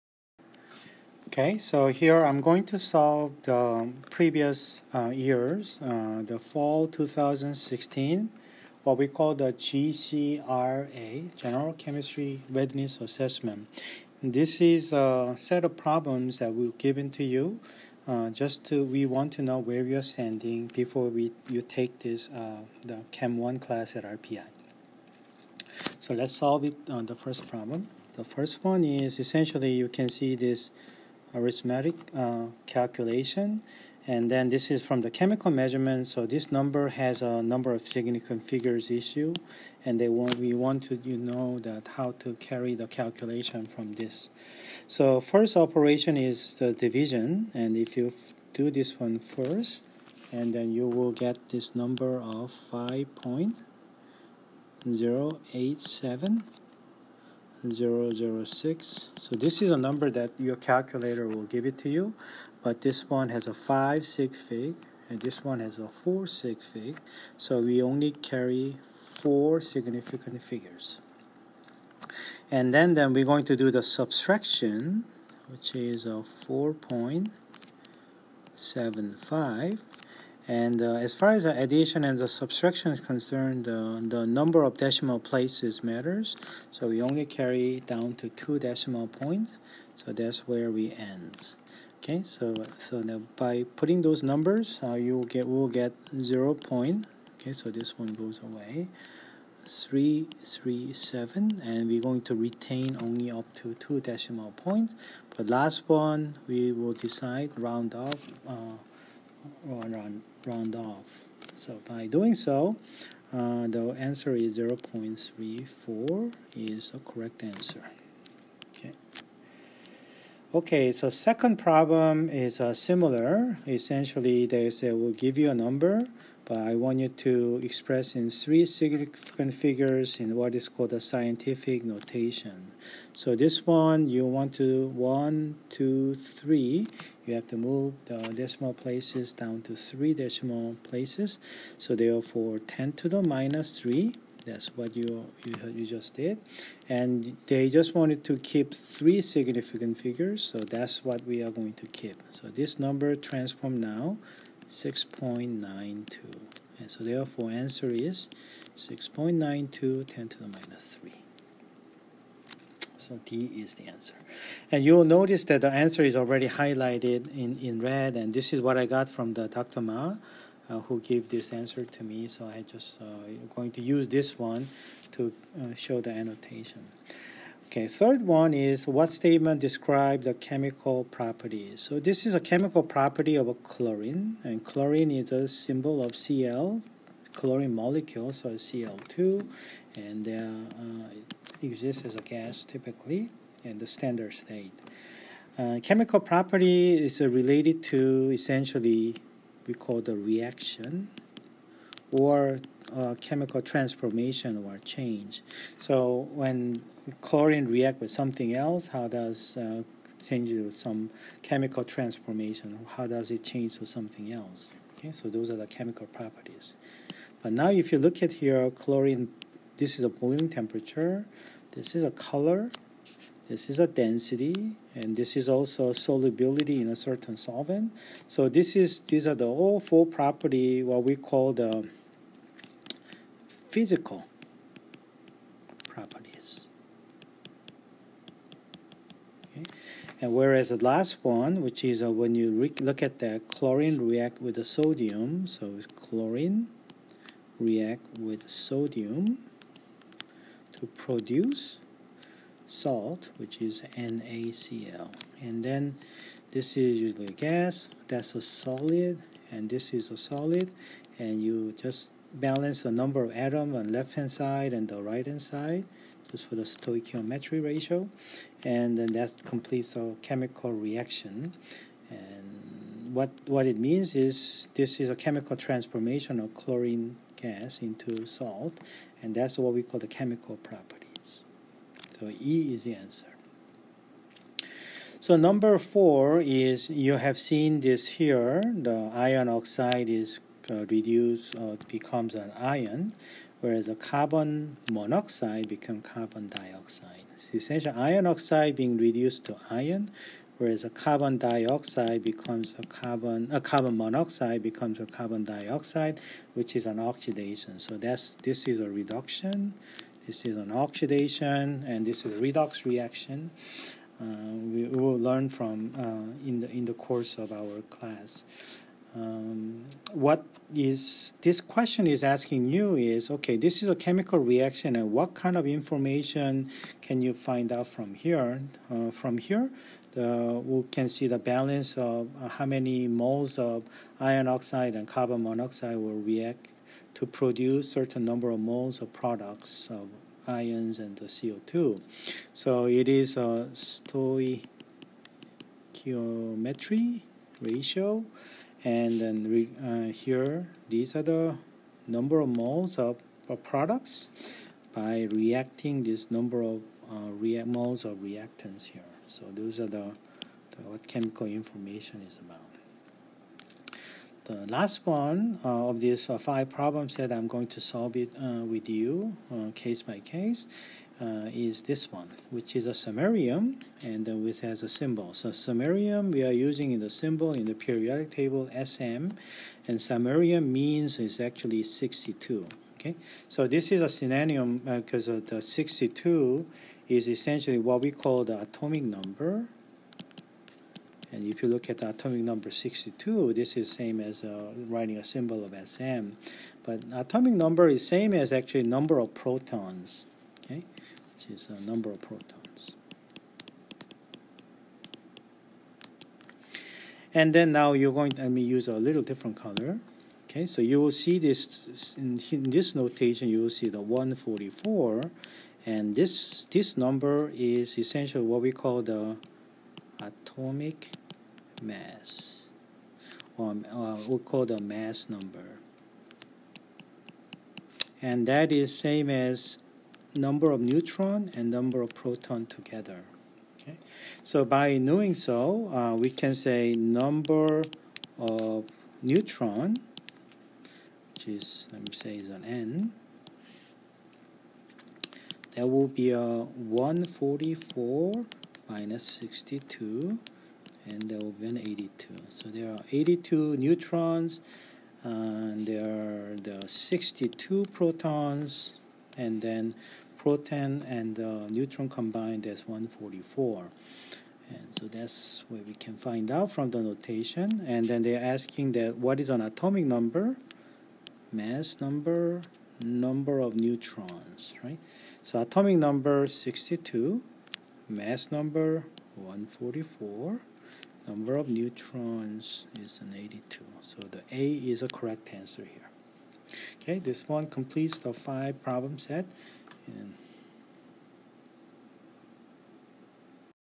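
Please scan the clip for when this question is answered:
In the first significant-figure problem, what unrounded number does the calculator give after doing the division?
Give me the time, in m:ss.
0:52.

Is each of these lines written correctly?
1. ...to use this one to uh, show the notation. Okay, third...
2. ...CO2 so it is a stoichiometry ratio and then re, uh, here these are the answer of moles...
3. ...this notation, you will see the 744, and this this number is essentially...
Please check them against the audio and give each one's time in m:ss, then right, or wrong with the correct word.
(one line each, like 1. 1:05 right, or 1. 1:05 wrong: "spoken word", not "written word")
1. 2:53 wrong: "annotation", not "notation"
2. 5:41 wrong: "number", not "answer"
3. 6:52 wrong: "144", not "744".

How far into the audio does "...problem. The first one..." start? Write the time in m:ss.
0:27.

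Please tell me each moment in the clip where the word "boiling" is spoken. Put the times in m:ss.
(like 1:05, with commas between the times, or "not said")
3:40.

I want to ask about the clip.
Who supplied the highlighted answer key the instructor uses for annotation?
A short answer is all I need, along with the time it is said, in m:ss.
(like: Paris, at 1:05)
Dr. Ma, at 2:49.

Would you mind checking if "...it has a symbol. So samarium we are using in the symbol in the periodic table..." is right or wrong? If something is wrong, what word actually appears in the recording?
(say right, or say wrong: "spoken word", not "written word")
right.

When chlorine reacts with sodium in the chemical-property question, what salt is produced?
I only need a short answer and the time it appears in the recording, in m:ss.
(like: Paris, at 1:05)
NaCl, at 4:13.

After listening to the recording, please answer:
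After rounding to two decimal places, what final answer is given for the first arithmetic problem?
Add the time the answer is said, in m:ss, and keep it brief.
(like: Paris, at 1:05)
0.34, at 1:54.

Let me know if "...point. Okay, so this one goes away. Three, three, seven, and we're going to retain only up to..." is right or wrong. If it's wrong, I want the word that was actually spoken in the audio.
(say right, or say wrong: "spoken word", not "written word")
right.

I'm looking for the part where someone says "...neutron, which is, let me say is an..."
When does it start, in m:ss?
7:19.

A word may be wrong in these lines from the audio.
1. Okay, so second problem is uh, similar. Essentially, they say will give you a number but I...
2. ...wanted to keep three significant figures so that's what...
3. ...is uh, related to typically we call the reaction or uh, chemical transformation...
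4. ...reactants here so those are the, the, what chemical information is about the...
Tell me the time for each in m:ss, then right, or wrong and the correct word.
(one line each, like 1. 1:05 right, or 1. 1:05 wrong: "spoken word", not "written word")
1. 2:00 right
2. 2:27 right
3. 3:17 wrong: "essentially", not "typically"
4. 5:58 right.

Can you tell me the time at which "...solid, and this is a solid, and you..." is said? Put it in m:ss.
4:18.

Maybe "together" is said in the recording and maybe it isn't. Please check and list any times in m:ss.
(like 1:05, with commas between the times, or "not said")
7:12.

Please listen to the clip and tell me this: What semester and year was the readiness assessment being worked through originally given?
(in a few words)
fall 2016.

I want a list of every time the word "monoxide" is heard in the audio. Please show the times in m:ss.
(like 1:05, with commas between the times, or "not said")
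4:54, 5:03, 5:35.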